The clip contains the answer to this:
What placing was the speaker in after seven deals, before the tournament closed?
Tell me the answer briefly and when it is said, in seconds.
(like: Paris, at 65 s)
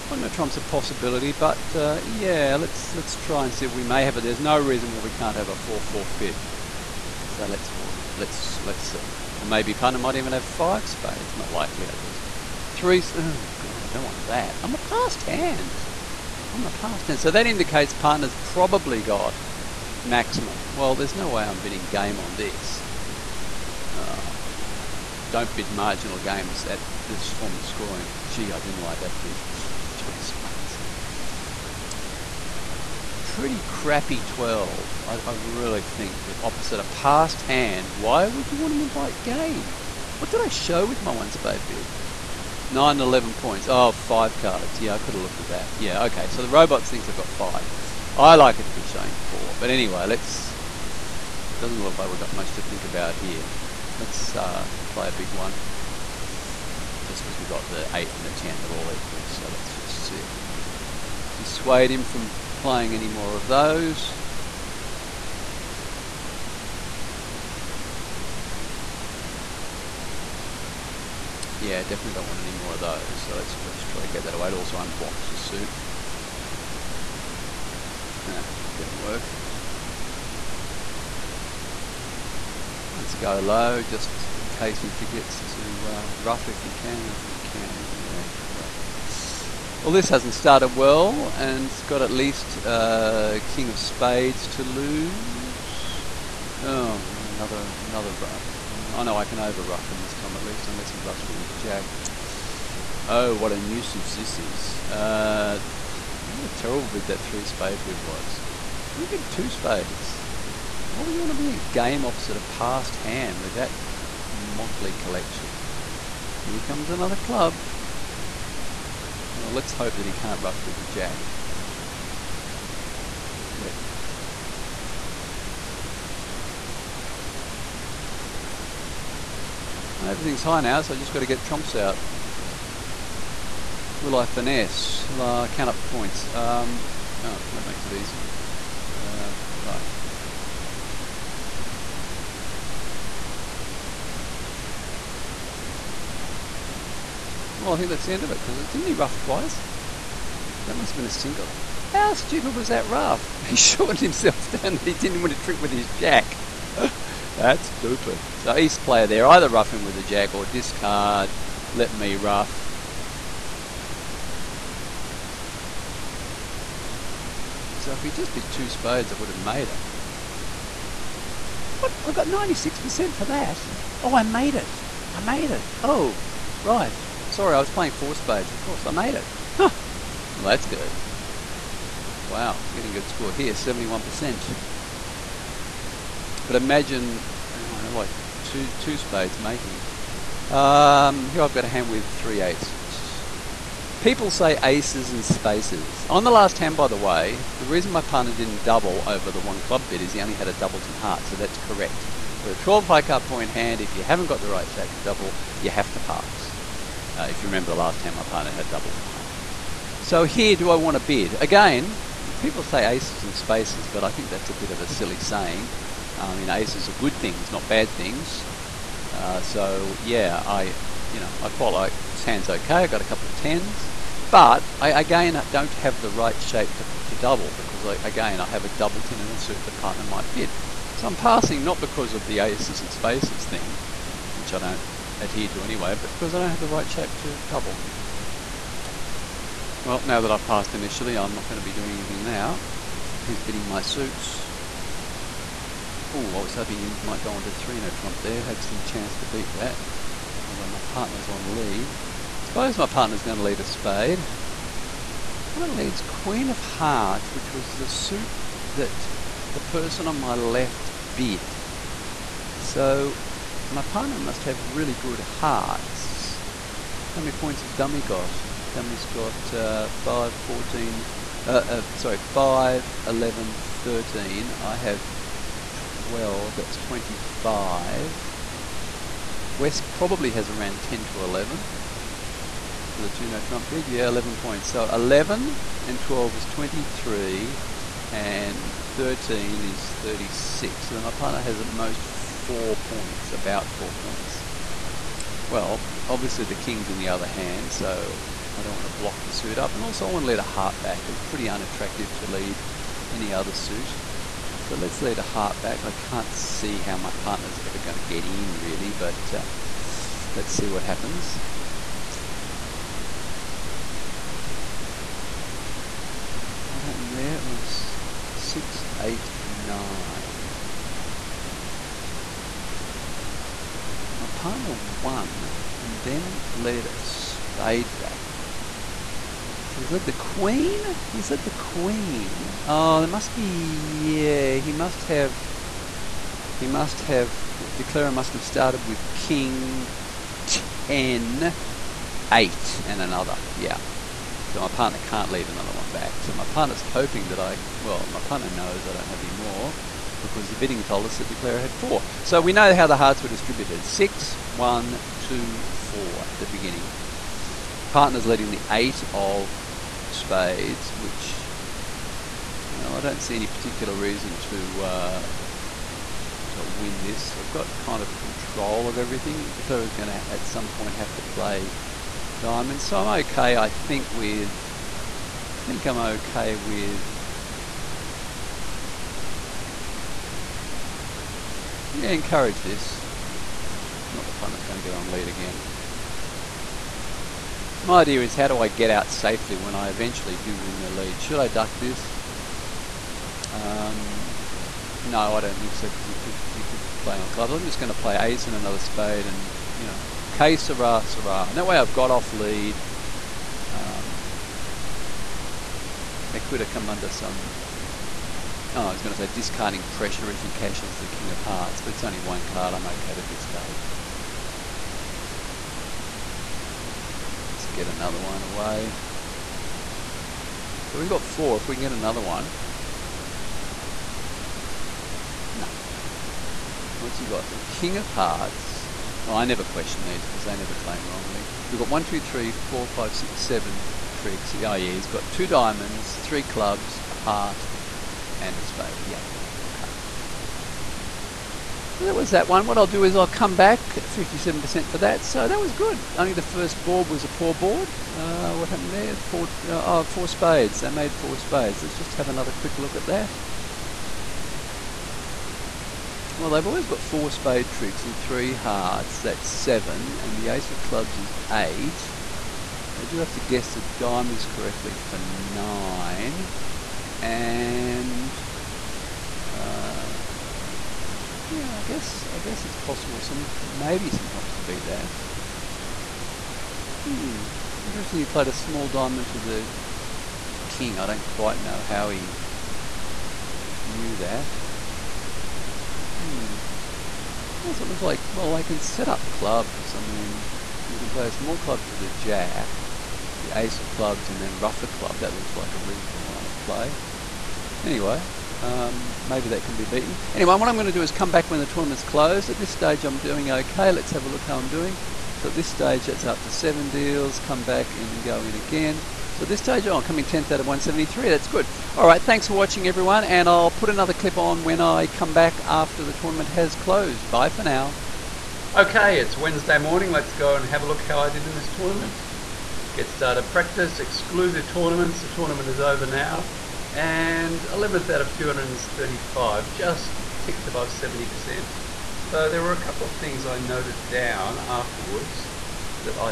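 10th, at 510 s.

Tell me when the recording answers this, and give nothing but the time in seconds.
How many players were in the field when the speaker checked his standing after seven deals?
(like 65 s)
510 s.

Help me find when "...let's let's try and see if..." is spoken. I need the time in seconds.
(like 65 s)
2 s.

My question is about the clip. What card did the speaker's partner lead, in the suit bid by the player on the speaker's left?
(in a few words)
Queen of Hearts.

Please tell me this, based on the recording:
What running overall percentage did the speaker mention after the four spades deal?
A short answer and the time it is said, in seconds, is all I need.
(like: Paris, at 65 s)
71%, at 183 s.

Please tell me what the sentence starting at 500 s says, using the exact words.
Anyway, what I'm going to do is come back when the tournament's closed.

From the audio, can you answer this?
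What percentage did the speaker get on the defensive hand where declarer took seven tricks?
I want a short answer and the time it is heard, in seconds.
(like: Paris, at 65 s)
57%, at 444 s.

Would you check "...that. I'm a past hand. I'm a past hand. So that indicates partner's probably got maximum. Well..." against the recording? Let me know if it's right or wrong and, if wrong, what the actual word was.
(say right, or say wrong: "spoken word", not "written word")
right.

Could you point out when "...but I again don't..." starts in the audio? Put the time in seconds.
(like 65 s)
224 s.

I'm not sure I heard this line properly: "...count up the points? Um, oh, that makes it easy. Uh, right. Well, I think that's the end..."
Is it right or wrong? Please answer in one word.
right.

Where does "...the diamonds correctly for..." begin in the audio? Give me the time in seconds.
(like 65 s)
463 s.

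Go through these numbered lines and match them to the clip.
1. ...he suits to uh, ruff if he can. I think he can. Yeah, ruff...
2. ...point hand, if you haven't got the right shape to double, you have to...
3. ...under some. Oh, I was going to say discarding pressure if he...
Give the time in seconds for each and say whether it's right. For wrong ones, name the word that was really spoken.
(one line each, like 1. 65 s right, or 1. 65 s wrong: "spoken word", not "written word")
1. 84 s wrong: "forgets", not "suits"
2. 203 s right
3. 406 s right.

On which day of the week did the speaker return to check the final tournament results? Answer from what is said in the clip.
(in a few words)
Wednesday.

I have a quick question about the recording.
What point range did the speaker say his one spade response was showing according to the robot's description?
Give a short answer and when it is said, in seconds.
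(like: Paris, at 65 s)
9-11 points, at 42 s.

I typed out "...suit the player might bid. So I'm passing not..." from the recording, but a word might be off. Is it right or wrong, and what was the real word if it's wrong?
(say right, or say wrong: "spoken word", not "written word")
wrong: "partner", not "player".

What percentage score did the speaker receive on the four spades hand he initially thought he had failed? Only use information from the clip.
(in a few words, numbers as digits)
96%.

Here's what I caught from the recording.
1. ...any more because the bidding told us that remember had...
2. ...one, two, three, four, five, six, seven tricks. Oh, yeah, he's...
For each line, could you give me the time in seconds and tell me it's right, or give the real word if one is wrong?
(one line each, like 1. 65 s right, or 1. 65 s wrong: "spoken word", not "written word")
1. 349 s wrong: "declarer", not "remember"
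2. 431 s right.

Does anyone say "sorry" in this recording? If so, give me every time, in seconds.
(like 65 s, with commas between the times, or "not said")
177 s, 271 s.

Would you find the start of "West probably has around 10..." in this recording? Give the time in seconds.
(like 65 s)
279 s.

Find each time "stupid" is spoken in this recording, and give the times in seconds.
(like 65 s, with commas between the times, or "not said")
152 s, 157 s.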